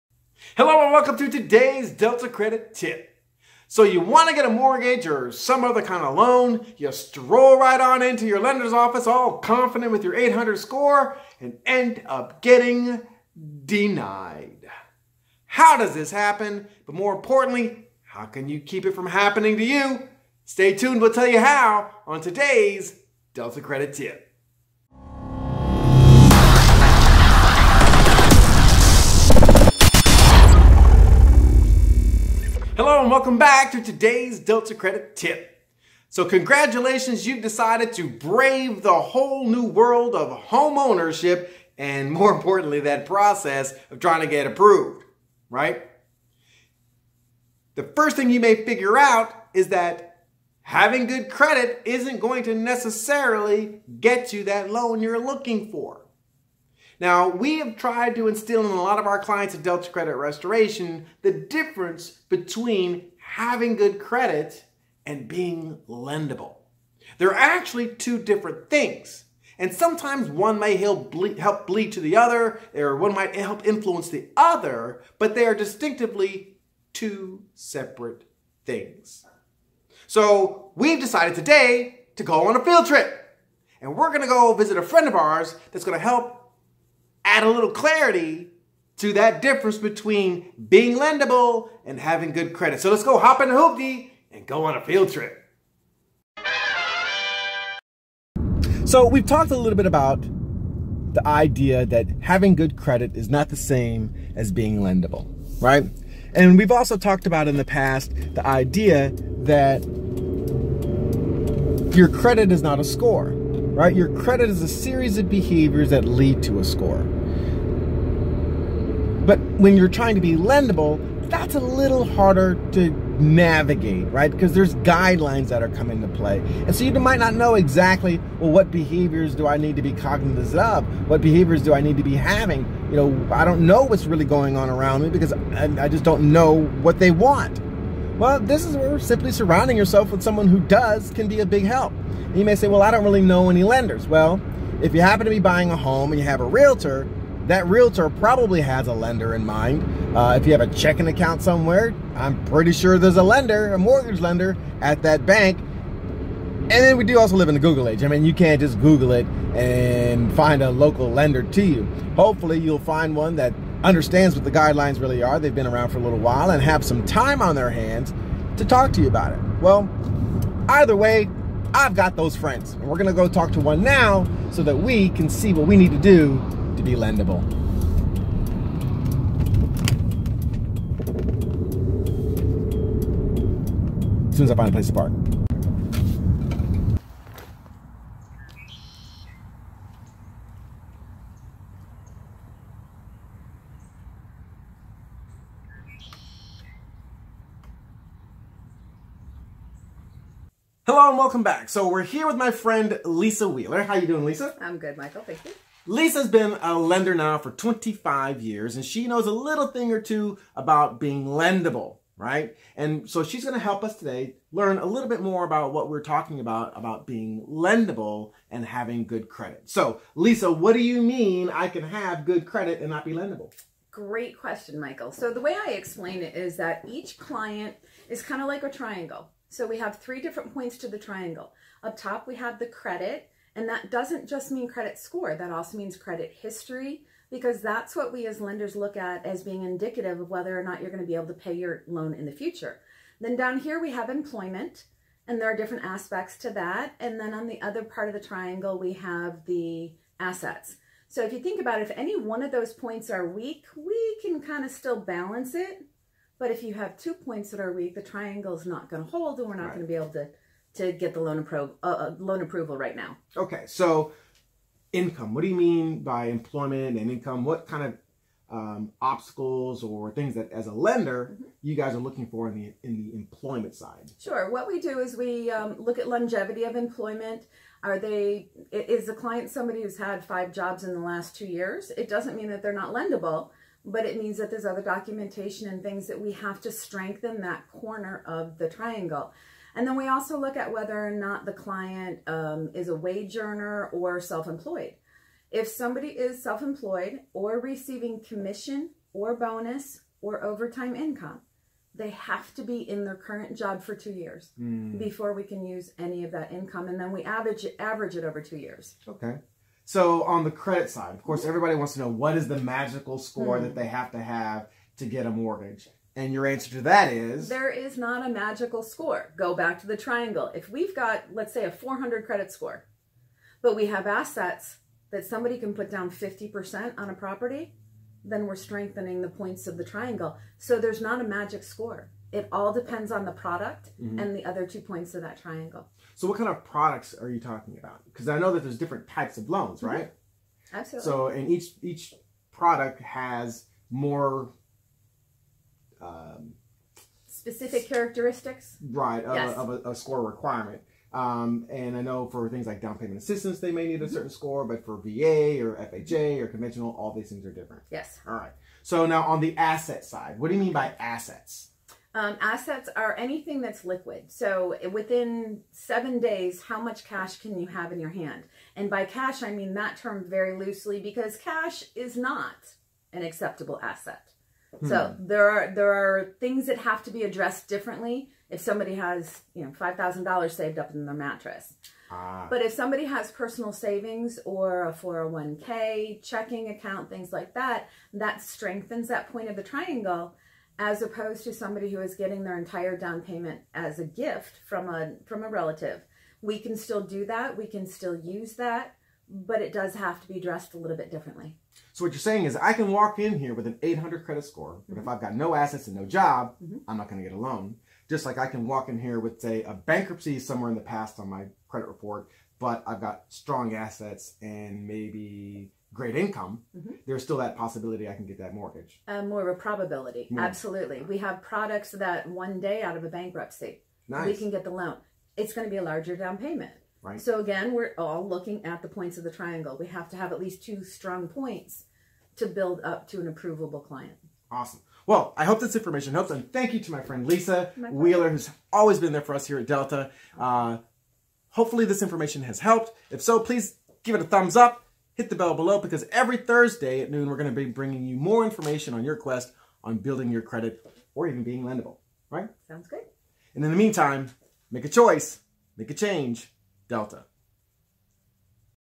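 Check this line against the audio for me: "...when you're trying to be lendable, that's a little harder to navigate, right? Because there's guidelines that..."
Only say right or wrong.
right.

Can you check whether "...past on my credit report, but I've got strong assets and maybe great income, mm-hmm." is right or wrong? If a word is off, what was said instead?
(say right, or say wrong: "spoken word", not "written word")
right.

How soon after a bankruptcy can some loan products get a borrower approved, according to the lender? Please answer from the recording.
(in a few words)
1 day.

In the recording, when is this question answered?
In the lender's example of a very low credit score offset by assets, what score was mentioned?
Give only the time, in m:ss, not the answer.
5:21.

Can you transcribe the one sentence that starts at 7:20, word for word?
Uh, hopefully, this information has helped.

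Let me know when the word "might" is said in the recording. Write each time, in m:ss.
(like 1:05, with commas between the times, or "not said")
1:13, 2:06.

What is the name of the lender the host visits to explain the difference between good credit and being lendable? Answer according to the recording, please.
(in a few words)
Lisa Wheeler.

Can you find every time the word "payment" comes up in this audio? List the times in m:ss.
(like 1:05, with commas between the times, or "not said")
5:52, 6:33, 7:06.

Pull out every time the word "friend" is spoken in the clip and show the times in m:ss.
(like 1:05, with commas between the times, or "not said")
1:24, 2:52, 3:22, 7:17.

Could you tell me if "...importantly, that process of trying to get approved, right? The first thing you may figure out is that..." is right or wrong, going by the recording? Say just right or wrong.
right.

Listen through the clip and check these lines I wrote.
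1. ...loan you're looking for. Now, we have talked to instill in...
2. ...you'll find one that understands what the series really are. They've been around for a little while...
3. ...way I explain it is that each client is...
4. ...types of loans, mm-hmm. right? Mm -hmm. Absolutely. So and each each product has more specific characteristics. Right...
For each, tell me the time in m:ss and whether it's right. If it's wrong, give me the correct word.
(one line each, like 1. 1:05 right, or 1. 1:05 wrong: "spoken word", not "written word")
1. 0:54 wrong: "tried", not "talked"
2. 2:42 wrong: "guidelines", not "series"
3. 3:45 right
4. 5:39 right.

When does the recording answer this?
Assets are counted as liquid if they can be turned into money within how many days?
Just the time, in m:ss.
6:05.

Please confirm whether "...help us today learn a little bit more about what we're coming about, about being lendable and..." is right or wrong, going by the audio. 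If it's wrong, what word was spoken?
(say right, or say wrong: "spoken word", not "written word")
wrong: "talking", not "coming".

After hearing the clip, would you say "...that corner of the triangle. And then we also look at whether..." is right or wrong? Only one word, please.
right.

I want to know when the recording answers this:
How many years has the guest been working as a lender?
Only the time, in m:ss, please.
3:27.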